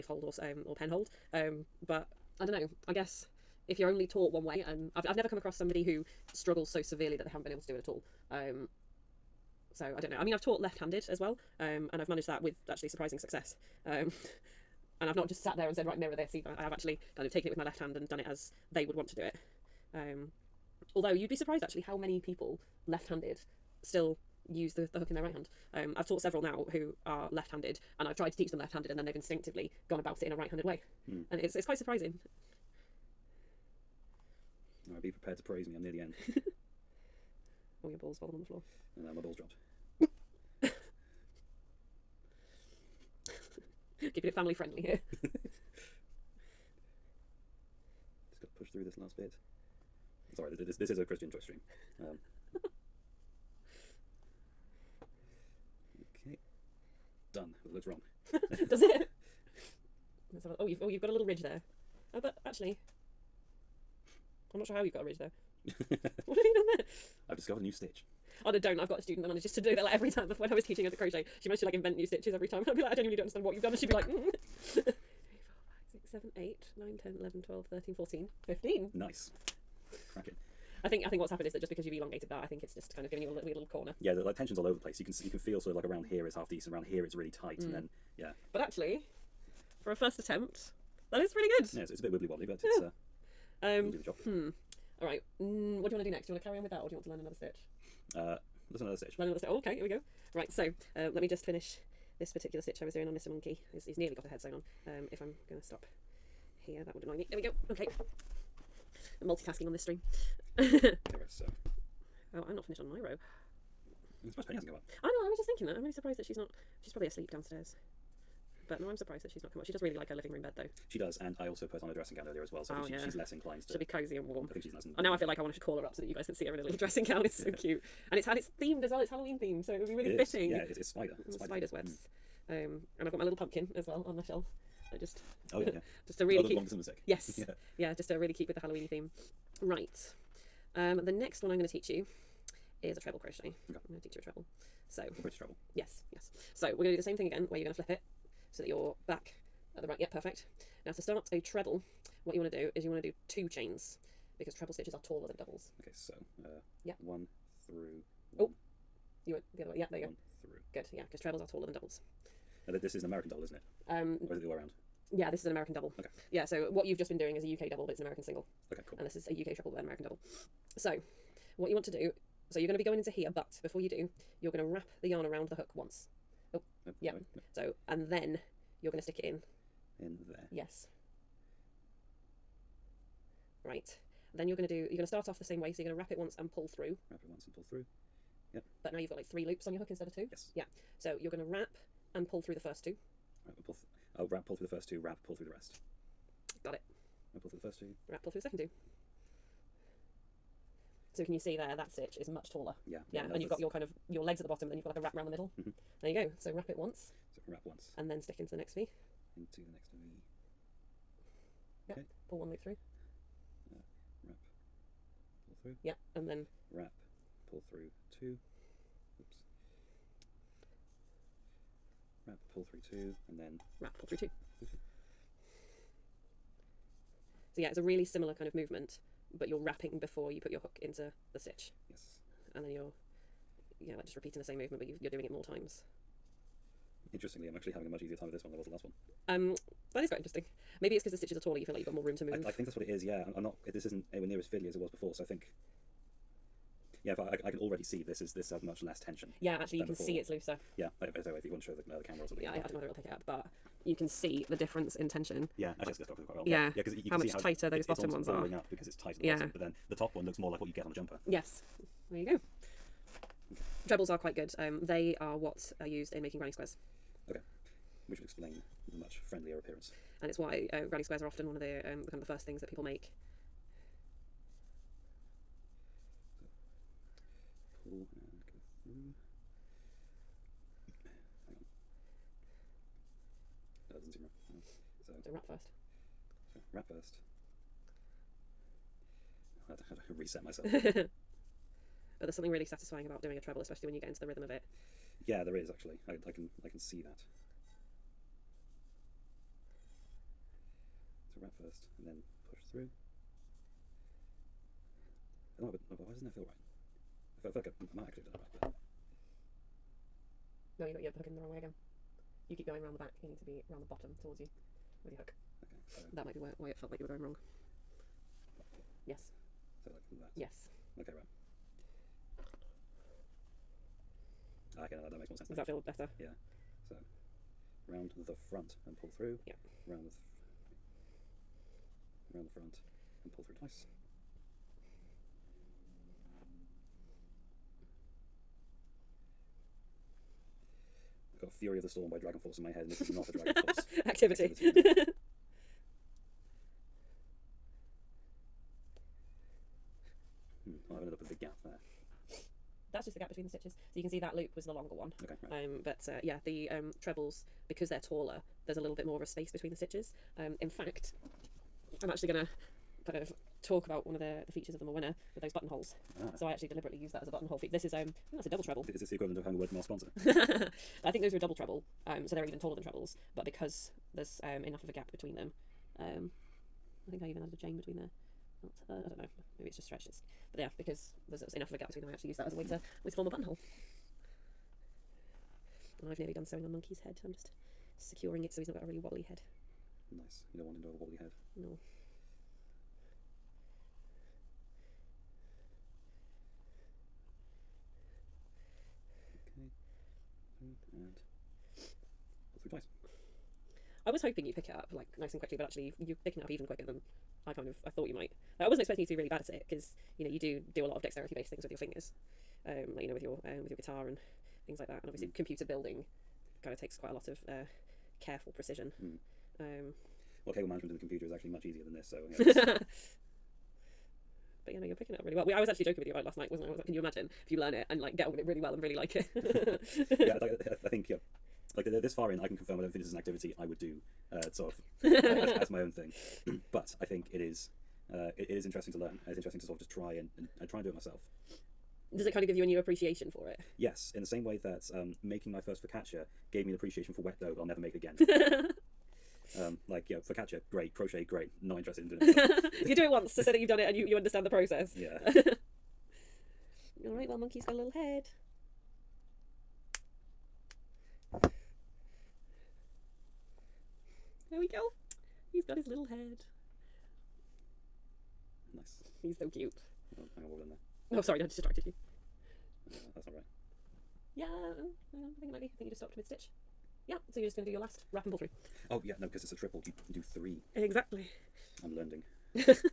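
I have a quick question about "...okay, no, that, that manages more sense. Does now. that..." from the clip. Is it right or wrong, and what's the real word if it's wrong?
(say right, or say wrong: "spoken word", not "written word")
wrong: "makes", not "manages".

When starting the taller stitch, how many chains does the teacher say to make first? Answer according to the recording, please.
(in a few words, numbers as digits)
2.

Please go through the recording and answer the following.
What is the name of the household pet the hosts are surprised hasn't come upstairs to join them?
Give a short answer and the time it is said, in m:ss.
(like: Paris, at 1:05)
Penny, at 1:54.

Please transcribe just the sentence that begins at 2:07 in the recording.
It's so cute and it's and it's themed as well.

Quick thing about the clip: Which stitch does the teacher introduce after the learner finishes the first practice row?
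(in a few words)
treble crochet.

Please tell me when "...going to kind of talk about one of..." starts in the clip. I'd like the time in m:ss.
6:02.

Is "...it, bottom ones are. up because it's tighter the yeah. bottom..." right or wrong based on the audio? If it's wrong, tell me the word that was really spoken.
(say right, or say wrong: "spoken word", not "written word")
right.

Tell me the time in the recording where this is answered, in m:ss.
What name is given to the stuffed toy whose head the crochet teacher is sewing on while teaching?
1:43.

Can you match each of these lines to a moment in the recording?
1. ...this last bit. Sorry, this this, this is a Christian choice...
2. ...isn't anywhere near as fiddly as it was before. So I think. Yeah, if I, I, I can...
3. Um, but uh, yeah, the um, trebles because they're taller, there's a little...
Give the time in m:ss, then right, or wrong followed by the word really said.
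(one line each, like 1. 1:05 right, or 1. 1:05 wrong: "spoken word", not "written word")
1. 0:48 right
2. 4:03 right
3. 5:55 right.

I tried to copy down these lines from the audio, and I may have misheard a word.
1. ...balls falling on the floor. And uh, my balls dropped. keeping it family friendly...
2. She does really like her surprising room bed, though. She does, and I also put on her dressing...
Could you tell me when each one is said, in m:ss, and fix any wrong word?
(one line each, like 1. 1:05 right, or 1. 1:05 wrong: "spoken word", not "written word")
1. 0:37 right
2. 1:59 wrong: "living", not "surprising".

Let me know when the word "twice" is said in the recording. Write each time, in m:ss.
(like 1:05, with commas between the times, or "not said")
5:33, 6:42.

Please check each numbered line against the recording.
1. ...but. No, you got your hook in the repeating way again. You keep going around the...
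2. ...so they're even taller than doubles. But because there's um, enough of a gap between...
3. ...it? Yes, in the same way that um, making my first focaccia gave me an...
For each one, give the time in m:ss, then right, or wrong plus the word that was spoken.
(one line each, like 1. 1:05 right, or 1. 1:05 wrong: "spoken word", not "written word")
1. 5:08 wrong: "wrong", not "repeating"
2. 6:12 wrong: "trebles", not "doubles"
3. 7:23 right.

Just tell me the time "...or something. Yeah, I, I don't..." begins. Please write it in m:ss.
4:12.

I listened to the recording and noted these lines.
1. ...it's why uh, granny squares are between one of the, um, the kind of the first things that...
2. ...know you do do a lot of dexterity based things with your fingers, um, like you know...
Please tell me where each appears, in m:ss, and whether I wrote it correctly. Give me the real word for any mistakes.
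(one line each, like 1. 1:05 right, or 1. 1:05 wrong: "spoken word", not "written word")
1. 4:30 wrong: "often", not "between"
2. 6:50 right.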